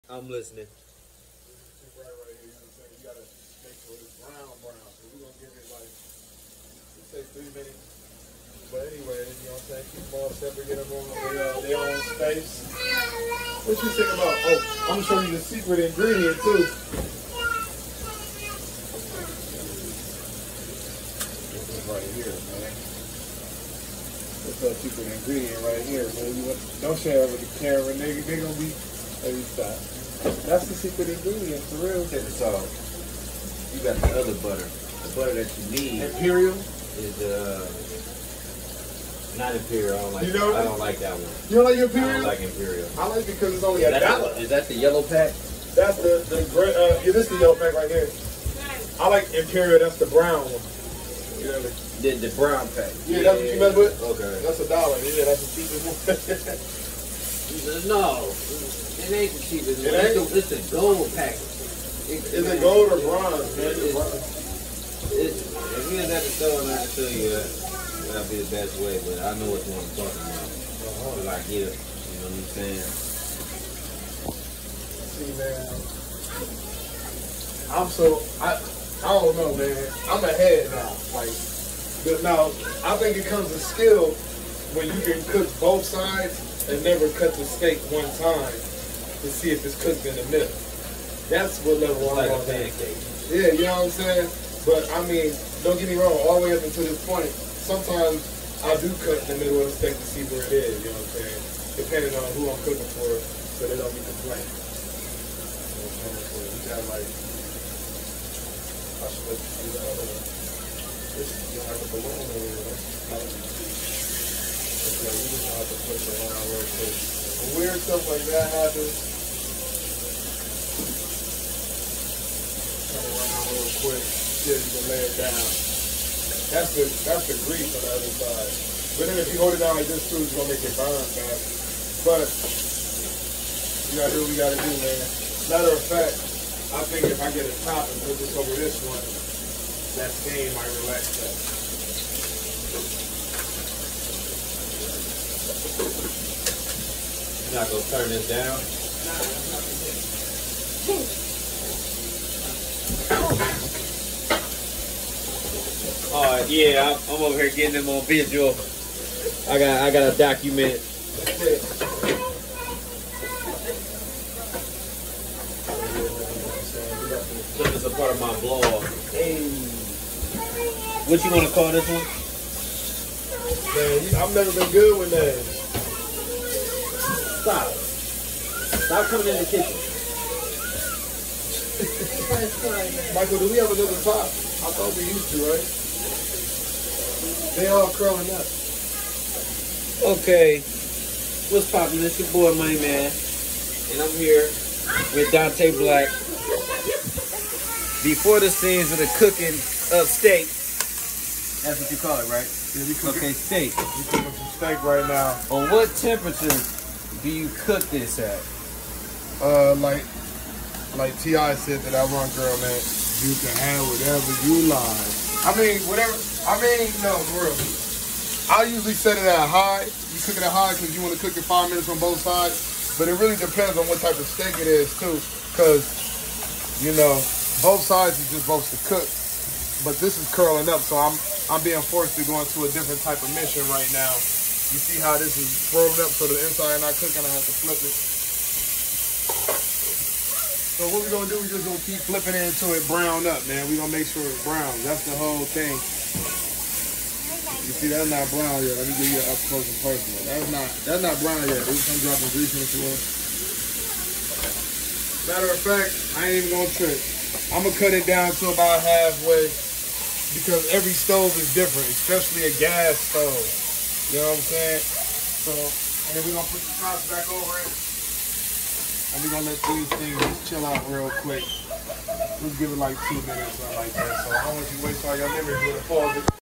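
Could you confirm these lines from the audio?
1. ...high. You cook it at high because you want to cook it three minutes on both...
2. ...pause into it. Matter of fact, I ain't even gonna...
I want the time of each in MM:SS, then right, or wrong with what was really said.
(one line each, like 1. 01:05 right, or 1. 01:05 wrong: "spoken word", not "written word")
1. 03:39 wrong: "five", not "three"
2. 04:12 wrong: "grease", not "pause".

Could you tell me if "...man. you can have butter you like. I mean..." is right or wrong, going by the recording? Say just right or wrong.
wrong.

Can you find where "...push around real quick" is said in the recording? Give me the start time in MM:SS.
01:55.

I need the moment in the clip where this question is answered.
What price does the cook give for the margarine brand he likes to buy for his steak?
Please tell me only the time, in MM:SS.
00:43.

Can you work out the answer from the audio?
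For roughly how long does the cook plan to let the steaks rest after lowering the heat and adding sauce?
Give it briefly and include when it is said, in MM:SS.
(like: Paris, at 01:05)
2 minutes, at 04:33.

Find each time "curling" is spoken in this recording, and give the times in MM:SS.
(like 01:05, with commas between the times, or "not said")
03:07, 03:50.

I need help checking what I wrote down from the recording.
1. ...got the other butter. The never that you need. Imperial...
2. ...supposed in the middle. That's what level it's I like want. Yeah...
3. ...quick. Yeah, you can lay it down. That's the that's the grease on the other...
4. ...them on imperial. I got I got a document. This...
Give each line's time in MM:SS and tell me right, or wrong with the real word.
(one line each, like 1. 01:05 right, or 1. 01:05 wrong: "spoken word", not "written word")
1. 00:33 wrong: "butter", not "never"
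2. 01:29 wrong: "cooked", not "supposed"
3. 02:03 right
4. 02:37 wrong: "visual", not "imperial".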